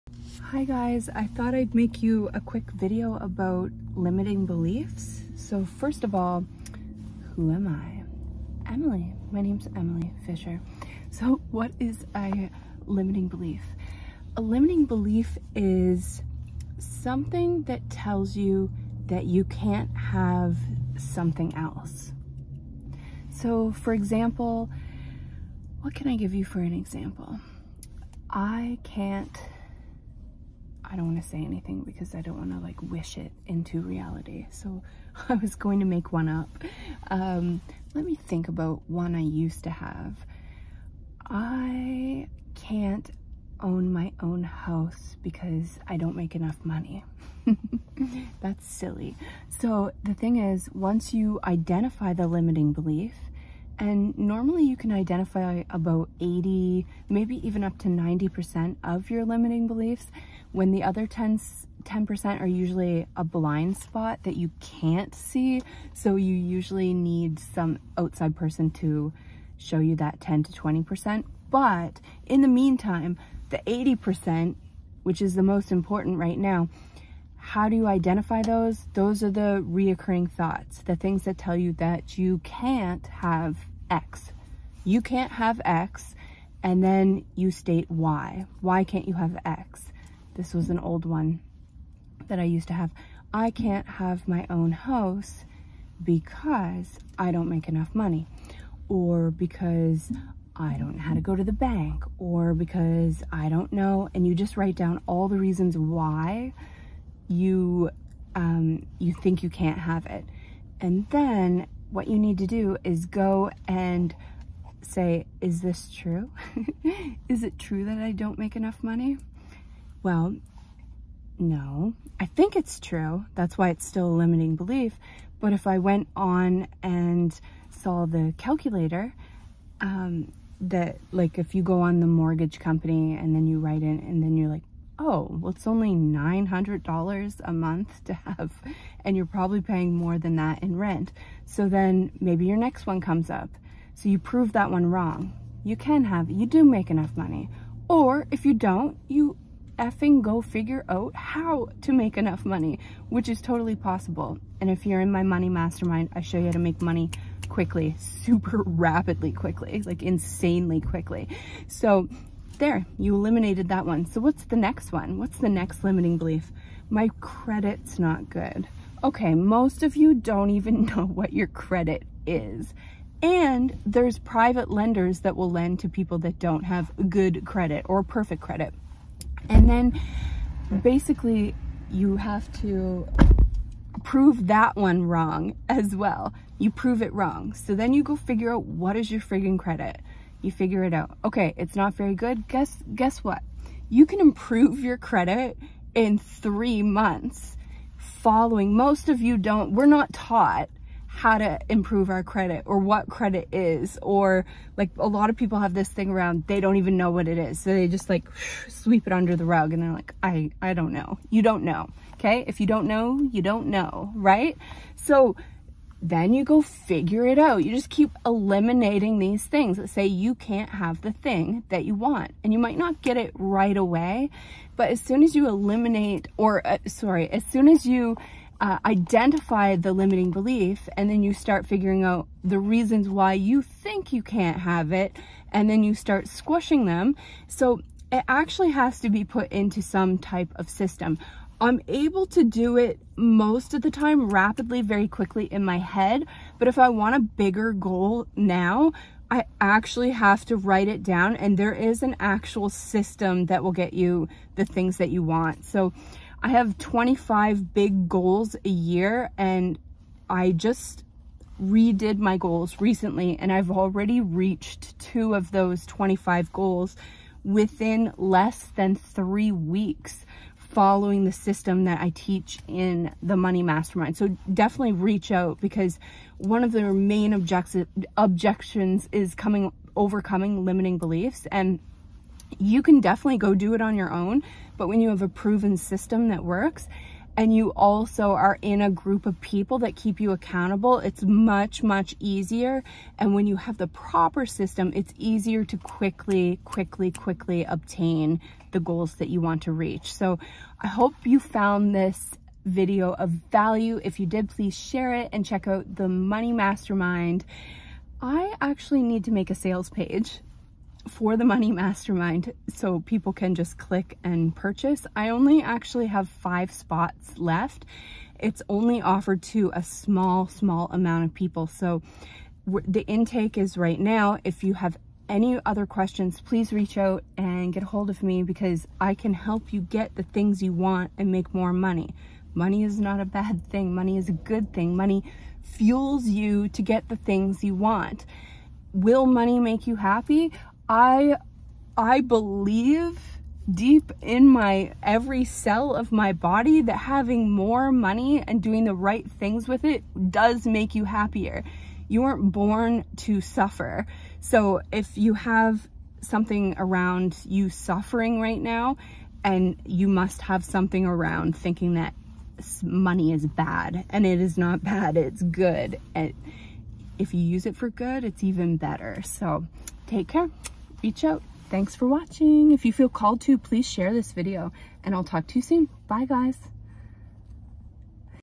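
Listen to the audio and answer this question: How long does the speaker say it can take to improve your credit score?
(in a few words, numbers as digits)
3 months.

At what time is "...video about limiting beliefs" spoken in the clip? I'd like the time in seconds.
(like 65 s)
2 s.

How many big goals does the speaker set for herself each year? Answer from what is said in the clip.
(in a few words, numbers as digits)
25.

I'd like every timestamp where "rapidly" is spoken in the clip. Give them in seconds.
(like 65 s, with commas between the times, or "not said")
158 s, 244 s.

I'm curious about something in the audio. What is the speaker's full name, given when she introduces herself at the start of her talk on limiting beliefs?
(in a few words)
Emily Fisher.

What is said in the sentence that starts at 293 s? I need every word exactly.
And when you have the proper system, it's easier to quickly, quickly, quickly obtain the goals that you want to reach.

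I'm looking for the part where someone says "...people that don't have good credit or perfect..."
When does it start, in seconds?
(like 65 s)
175 s.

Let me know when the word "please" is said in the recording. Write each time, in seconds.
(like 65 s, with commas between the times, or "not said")
304 s, 326 s, 373 s.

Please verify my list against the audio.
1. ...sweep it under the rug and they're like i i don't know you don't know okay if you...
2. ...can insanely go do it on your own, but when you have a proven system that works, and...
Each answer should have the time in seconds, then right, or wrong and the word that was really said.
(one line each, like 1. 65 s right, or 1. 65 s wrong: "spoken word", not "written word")
1. 208 s right
2. 282 s wrong: "definitely", not "insanely".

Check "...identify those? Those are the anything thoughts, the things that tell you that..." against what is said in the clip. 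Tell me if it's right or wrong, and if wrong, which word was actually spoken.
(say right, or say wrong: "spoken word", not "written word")
wrong: "reoccurring", not "anything".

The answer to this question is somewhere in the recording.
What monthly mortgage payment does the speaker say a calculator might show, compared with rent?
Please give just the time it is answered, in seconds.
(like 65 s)
135 s.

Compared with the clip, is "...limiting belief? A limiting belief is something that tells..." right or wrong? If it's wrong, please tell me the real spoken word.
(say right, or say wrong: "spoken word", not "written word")
right.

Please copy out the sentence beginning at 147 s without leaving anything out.
Or if you don't, you effing go figure out how to make enough money, which is totally possible.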